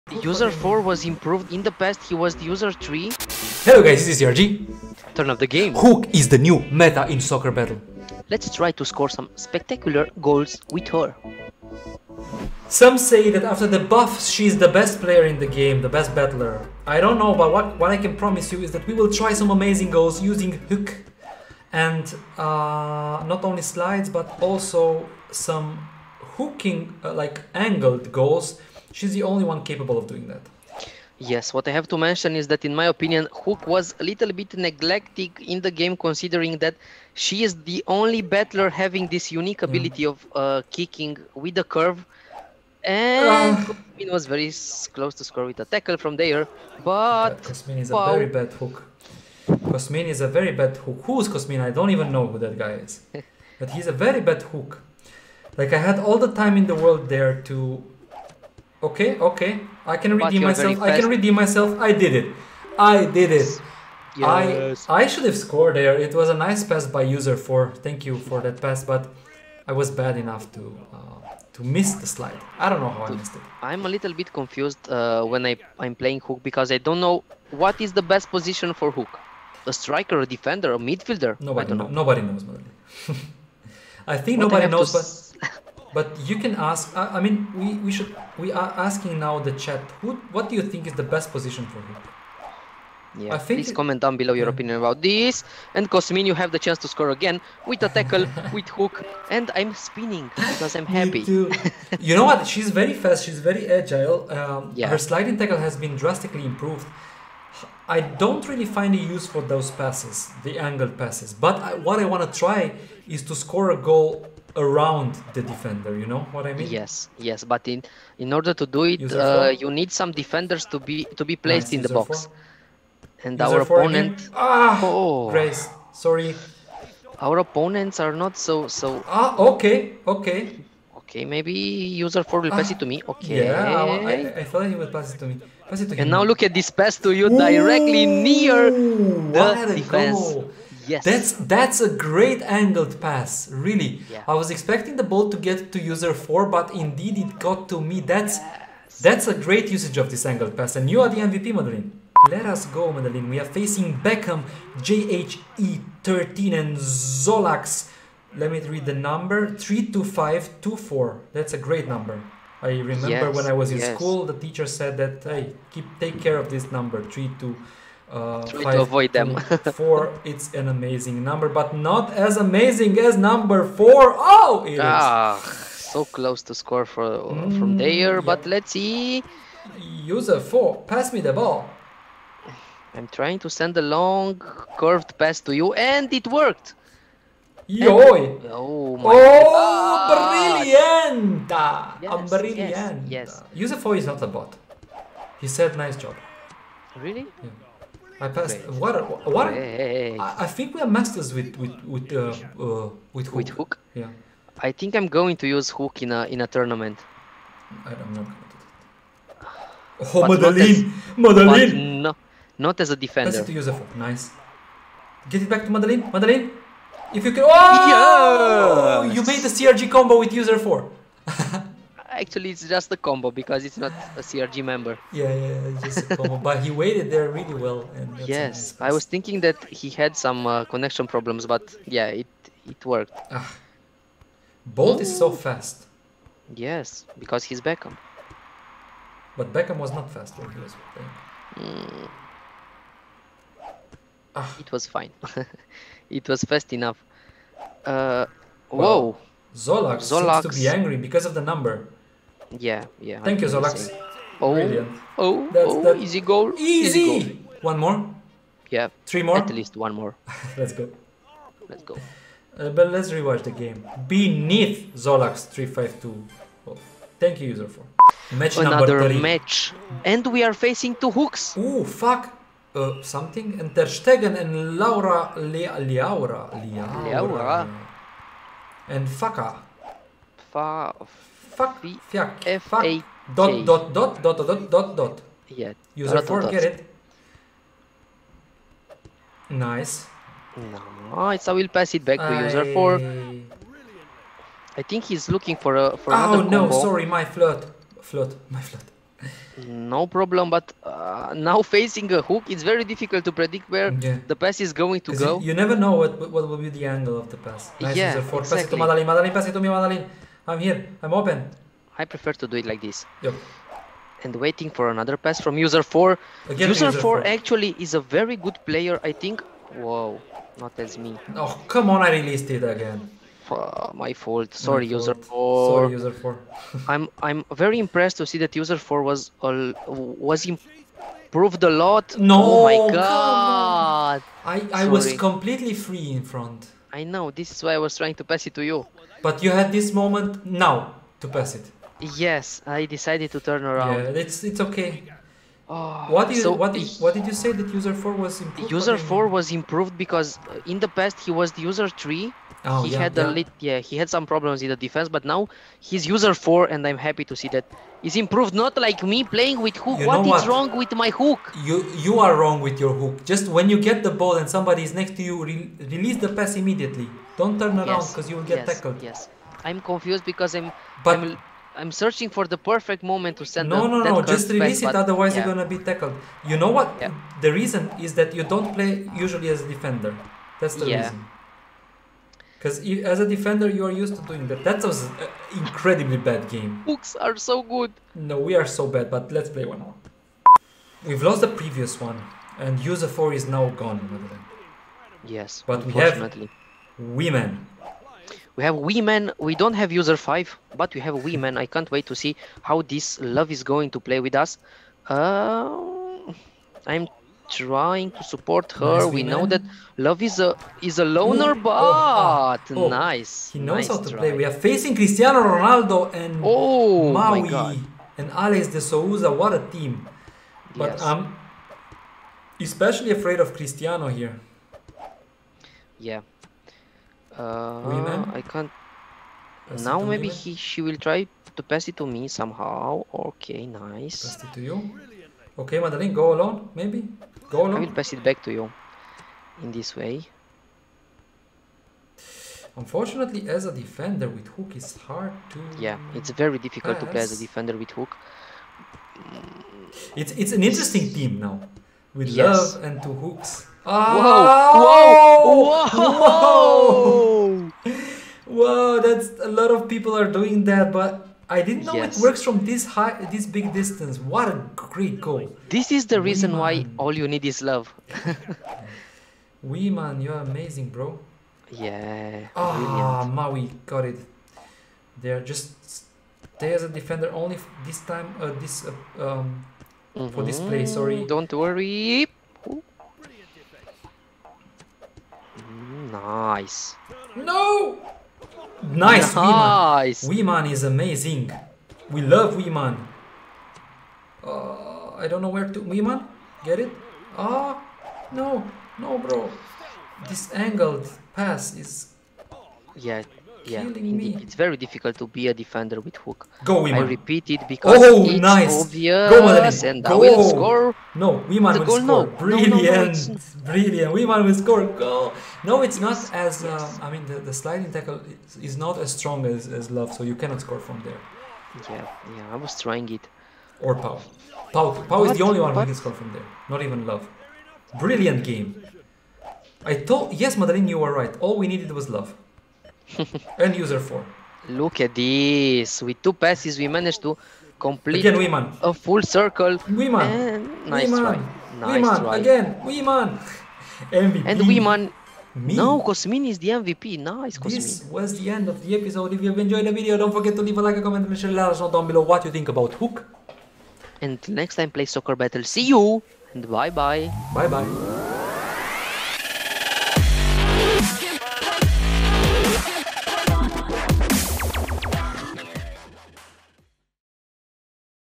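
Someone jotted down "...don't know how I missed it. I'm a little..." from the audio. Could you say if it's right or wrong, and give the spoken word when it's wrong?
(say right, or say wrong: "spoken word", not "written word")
right.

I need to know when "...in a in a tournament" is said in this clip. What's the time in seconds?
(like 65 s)
206 s.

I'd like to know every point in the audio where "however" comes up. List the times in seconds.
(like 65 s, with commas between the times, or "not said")
not said.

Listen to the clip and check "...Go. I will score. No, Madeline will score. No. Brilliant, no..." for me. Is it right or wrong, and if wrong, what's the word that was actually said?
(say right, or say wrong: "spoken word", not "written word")
wrong: "Wiman", not "Madeline".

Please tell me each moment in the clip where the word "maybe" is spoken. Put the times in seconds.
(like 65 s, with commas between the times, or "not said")
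131 s, 430 s, 436 s.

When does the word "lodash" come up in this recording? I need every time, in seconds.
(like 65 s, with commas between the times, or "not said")
not said.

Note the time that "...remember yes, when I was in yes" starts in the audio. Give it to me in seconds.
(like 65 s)
162 s.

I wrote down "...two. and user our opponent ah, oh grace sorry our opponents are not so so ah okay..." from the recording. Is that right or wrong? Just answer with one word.
wrong.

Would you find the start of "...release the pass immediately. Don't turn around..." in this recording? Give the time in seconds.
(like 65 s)
365 s.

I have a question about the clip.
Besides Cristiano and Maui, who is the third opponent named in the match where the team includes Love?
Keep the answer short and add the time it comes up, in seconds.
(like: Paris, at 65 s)
Alex de Souza, at 418 s.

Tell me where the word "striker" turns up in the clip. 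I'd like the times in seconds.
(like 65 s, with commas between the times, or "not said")
79 s.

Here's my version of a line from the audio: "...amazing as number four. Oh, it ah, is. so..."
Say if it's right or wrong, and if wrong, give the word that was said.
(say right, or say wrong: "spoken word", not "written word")
right.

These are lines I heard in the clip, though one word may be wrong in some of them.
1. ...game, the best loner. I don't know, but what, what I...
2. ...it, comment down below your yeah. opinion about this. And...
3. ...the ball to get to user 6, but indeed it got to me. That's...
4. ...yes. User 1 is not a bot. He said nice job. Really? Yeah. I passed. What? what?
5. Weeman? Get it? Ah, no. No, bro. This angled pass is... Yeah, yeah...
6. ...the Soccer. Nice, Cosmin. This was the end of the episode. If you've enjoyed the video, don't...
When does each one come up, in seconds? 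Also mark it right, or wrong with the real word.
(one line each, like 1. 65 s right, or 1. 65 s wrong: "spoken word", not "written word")
1. 15 s wrong: "battler", not "loner"
2. 93 s right
3. 145 s wrong: "4", not "6"
4. 193 s wrong: "4", not "1"
5. 495 s right
6. 546 s wrong: "MVP", not "Soccer".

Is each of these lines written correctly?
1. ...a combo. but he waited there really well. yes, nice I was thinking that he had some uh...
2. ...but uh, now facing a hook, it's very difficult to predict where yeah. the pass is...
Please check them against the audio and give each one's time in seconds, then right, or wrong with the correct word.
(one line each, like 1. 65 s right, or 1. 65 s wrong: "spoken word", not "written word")
1. 226 s right
2. 300 s right.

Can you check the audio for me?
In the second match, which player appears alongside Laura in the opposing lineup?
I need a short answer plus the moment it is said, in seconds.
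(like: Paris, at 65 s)
Ter Stegen, at 273 s.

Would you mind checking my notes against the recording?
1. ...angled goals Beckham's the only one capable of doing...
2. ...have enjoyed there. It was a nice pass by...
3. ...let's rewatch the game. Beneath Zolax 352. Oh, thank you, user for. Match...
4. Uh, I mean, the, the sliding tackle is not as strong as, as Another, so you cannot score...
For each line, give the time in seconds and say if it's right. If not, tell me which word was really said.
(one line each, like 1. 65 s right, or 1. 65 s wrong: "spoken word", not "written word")
1. 27 s wrong: "She", not "Beckham"
2. 65 s wrong: "scored", not "enjoyed"
3. 262 s right
4. 516 s wrong: "Love", not "Another".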